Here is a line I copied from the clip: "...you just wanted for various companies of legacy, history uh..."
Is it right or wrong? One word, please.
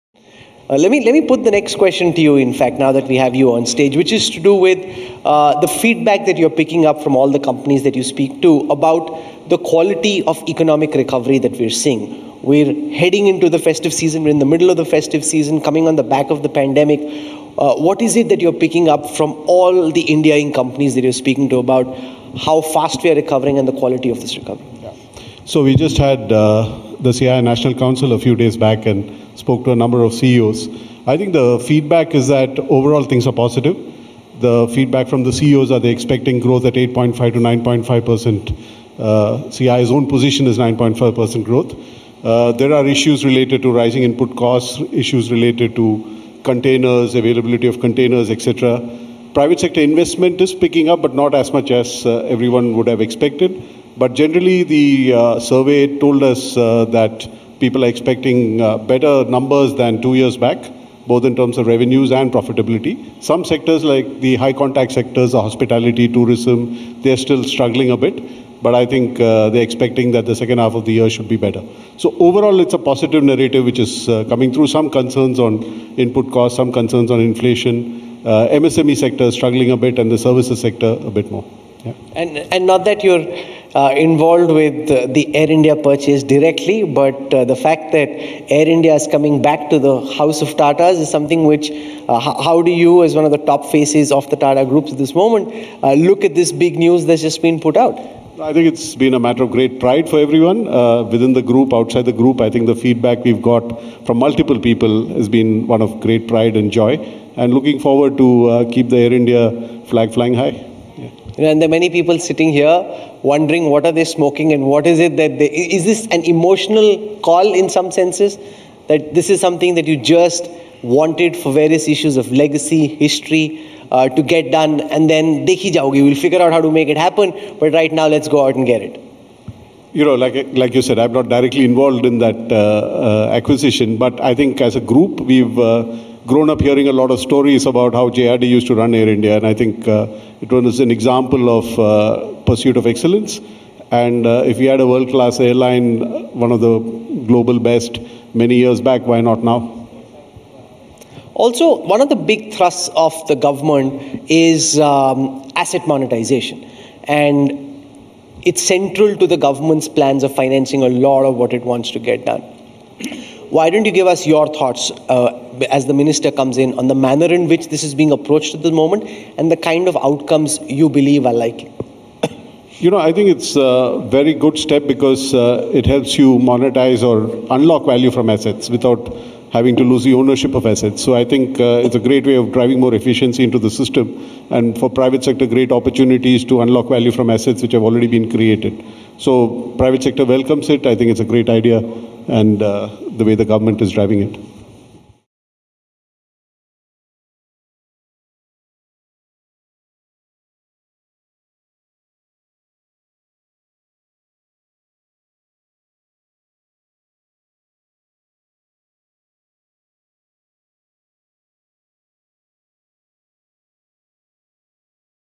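wrong.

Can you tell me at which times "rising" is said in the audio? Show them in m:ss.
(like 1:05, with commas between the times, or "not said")
0:43.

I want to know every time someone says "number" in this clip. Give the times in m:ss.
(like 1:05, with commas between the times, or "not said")
0:29, 0:59.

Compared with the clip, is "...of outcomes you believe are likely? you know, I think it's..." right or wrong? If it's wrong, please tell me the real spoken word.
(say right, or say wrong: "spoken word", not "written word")
right.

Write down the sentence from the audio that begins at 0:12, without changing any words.
We're heading into the festive season, we're in the middle of the festive season, coming on the back of the pandemic.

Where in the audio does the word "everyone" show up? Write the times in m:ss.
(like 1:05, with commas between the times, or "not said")
0:52, 1:40.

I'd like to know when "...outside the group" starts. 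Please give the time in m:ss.
1:41.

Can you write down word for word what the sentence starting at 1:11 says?
So overall, it's a positive narrative which is uh, coming through.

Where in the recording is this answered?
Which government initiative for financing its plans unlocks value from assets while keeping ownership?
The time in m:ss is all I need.
2:35.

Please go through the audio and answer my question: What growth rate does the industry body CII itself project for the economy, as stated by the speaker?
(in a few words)
9.5 percent.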